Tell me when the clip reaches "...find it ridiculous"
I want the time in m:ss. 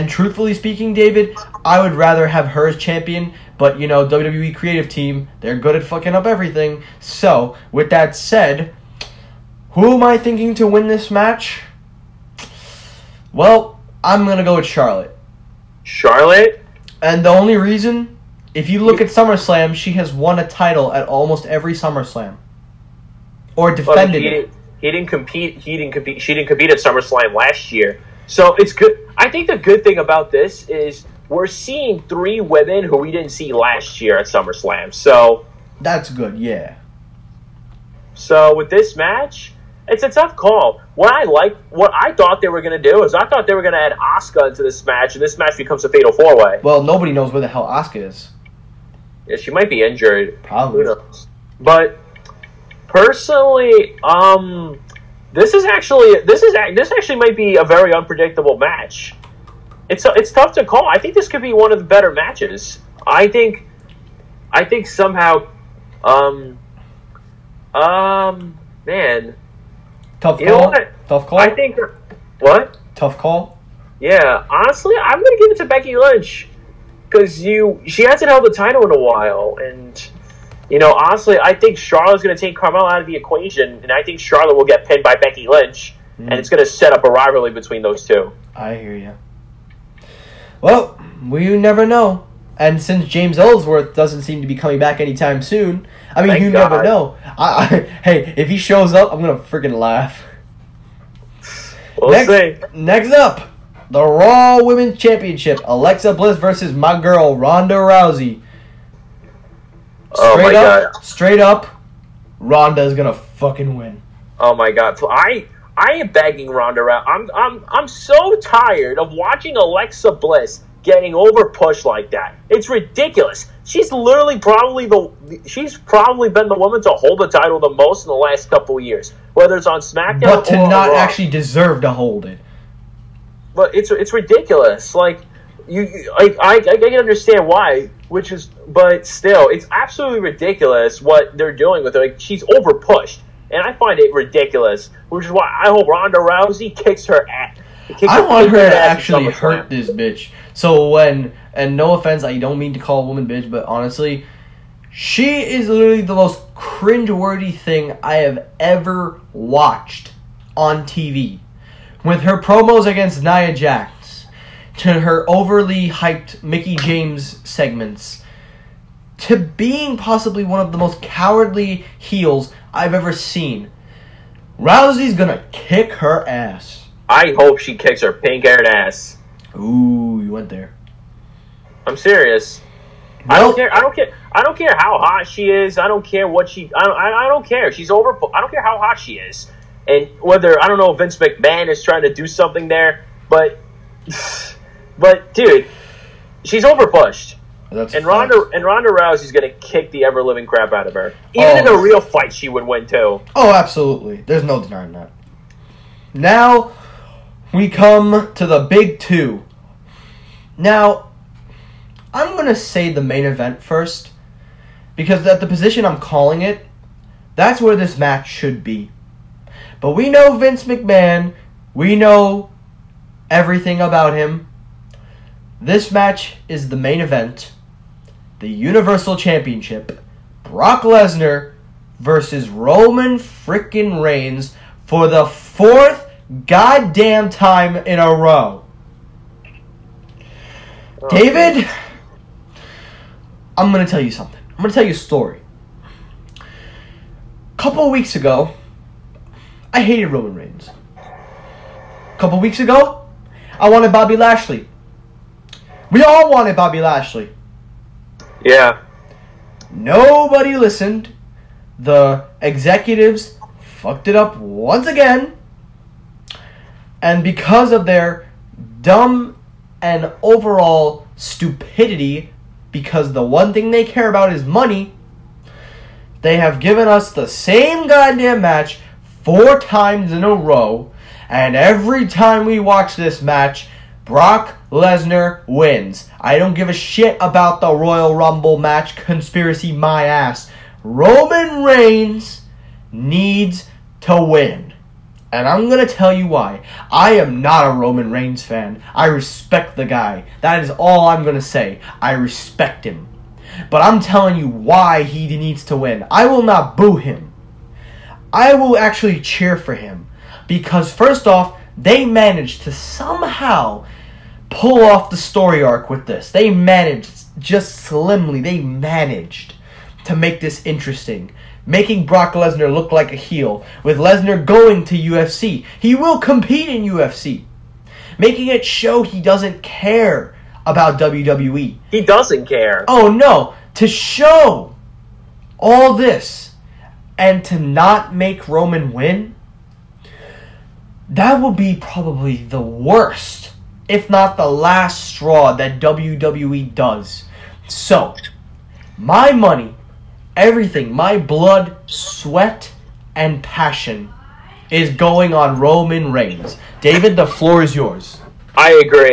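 2:23.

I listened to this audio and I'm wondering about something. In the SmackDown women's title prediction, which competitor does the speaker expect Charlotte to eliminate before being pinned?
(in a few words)
Carmella.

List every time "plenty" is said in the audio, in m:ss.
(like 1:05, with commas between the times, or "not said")
not said.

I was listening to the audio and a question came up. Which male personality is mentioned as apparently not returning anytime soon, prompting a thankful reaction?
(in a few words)
James Ellsworth.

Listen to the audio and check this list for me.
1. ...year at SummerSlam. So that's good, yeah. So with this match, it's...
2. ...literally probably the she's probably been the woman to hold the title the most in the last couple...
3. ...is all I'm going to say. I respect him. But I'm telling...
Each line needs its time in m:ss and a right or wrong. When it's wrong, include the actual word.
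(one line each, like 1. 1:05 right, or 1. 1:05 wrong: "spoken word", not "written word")
1. 0:34 right
2. 2:03 right
3. 5:00 right.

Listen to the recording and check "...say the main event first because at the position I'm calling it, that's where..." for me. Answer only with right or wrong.
right.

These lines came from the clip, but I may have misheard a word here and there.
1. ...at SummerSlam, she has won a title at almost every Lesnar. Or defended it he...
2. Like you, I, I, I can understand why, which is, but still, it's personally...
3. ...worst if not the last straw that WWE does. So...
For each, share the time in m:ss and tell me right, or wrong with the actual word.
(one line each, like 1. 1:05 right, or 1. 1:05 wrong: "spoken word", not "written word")
1. 0:19 wrong: "SummerSlam", not "Lesnar"
2. 2:14 wrong: "absolutely", not "personally"
3. 5:42 right.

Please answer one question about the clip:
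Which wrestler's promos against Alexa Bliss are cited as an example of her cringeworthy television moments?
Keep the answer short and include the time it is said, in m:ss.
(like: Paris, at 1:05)
Nia Jax, at 2:43.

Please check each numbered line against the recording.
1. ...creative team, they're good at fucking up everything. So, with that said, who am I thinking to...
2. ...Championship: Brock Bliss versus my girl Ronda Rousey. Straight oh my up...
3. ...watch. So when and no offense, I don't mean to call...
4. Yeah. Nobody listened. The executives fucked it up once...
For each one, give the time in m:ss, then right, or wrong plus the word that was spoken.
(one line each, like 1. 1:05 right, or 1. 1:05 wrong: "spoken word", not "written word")
1. 0:04 right
2. 1:44 wrong: "Alexa", not "Brock"
3. 2:29 wrong: "bitch", not "watch"
4. 4:18 right.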